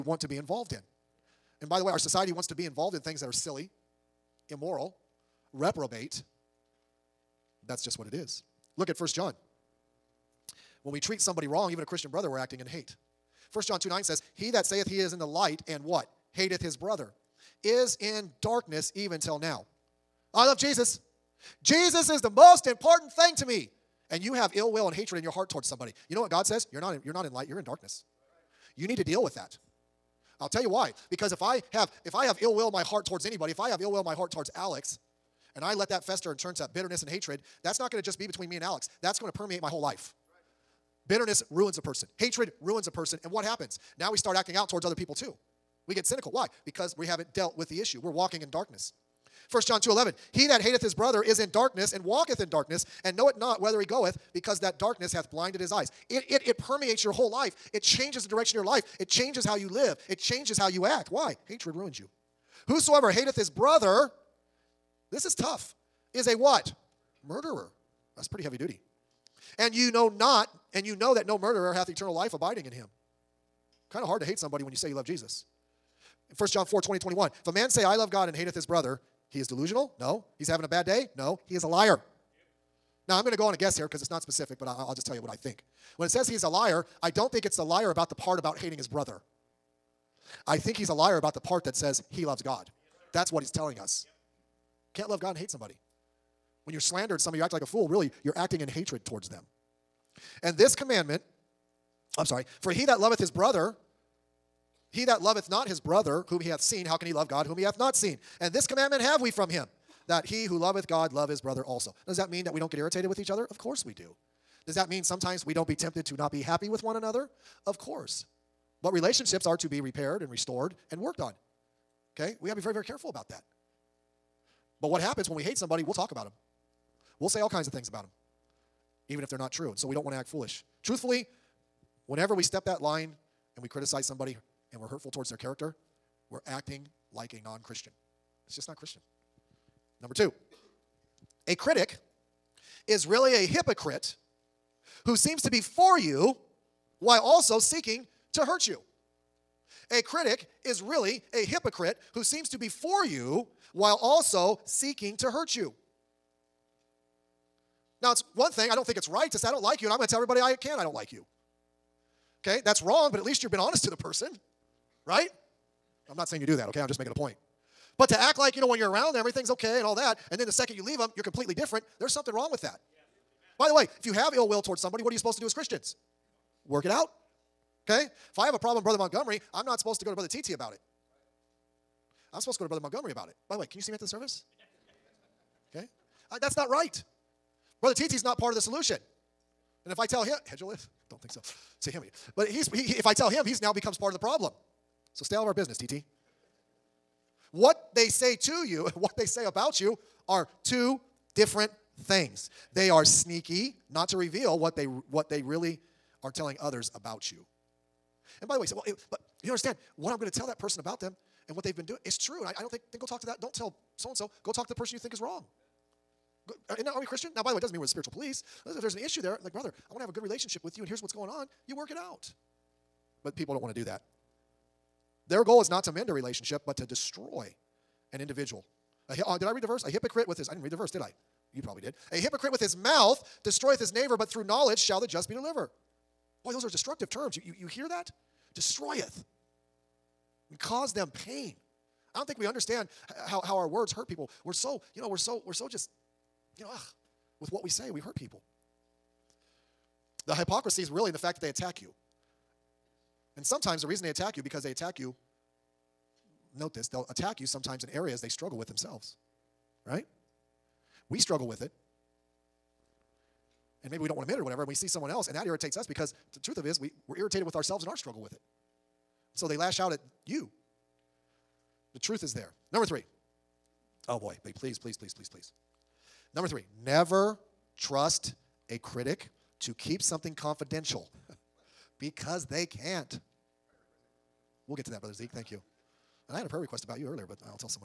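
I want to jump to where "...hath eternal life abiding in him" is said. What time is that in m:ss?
1:11.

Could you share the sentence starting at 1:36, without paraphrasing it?
When you're slandered, some of you act like a fool, really, you're acting in hatred towards them.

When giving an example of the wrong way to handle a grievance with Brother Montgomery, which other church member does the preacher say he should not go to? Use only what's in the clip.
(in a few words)
Brother TT.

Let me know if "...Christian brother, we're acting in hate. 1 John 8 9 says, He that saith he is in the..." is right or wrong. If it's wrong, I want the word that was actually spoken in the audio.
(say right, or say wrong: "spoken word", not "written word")
wrong: "2", not "8".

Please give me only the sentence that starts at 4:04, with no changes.
We're so, you know, we're so, we're so just, you know, ugh, with what we say, we hurt people.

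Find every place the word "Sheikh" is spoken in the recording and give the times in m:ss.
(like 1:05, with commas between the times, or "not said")
not said.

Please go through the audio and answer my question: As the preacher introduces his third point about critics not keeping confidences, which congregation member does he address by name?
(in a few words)
Brother Zeke.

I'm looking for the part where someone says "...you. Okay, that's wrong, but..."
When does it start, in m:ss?
2:41.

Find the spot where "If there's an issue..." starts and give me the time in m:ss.
3:38.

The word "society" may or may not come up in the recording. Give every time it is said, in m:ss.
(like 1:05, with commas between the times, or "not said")
0:01.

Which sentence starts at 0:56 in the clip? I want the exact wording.
It, it, it permeates your whole life.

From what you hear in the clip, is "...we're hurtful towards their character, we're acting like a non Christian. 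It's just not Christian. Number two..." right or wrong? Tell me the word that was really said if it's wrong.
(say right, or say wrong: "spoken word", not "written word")
right.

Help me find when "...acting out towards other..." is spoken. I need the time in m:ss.
0:44.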